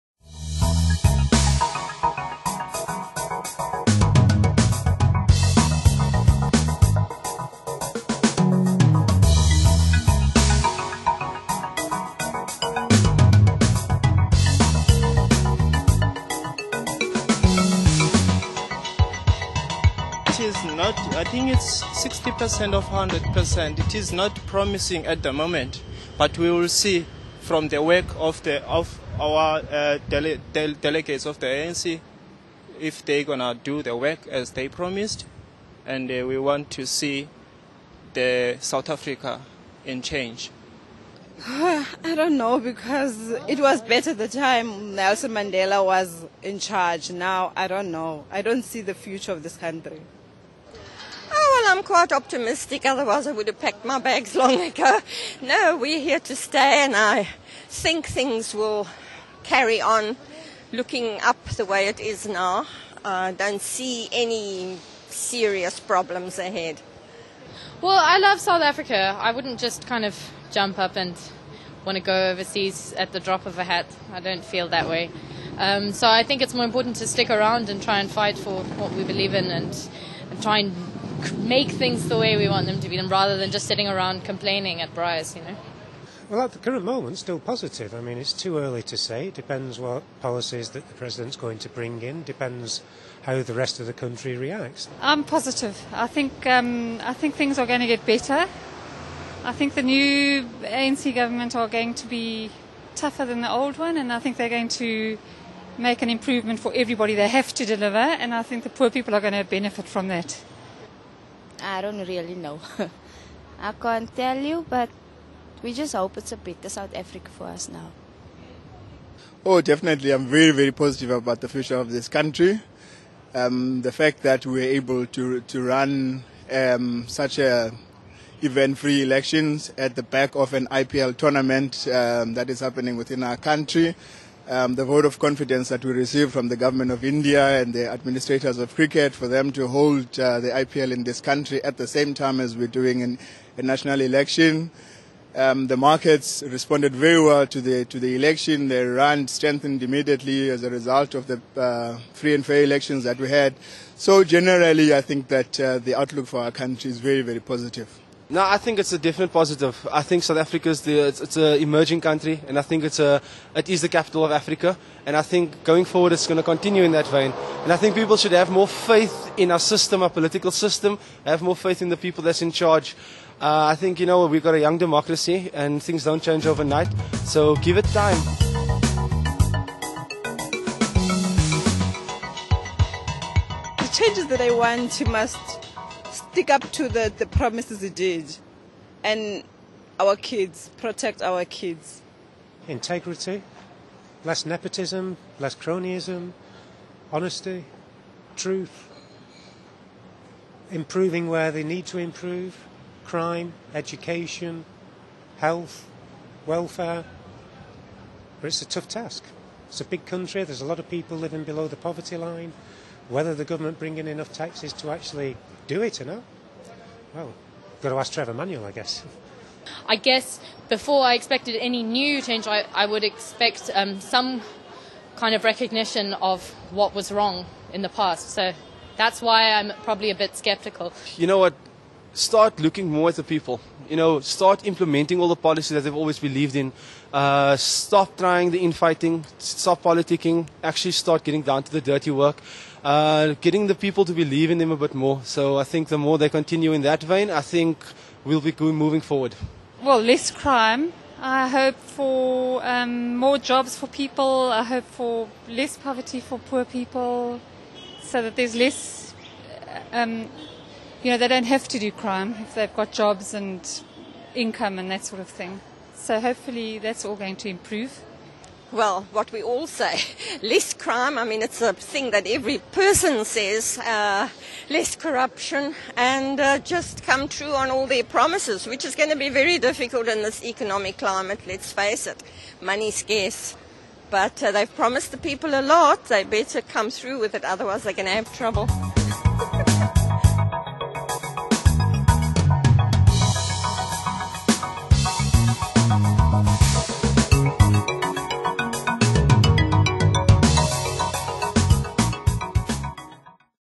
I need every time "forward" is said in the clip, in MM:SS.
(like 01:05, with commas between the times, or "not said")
02:45, 04:09.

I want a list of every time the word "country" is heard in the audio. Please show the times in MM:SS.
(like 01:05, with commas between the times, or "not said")
00:49, 01:33, 02:02, 02:13, 02:21, 02:36, 02:41, 03:30.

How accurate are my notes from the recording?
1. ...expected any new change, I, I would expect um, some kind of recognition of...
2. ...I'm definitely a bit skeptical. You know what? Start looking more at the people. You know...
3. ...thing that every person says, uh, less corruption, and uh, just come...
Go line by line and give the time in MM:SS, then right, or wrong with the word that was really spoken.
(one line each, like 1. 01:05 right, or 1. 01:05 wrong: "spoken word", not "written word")
1. 03:41 right
2. 03:49 wrong: "probably", not "definitely"
3. 04:31 right.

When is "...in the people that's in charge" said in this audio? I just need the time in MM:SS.
02:51.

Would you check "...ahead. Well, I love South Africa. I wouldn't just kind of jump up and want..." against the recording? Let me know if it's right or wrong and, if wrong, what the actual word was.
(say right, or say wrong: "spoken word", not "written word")
right.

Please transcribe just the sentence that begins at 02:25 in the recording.
Um, the markets responded very well to the to the election.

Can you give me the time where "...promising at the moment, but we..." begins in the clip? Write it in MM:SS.
00:24.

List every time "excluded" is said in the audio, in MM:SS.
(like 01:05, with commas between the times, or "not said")
not said.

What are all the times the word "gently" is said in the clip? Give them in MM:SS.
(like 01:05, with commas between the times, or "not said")
not said.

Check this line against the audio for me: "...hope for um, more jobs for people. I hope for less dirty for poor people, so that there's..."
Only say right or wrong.
wrong.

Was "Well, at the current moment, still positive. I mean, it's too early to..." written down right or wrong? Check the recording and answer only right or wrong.
right.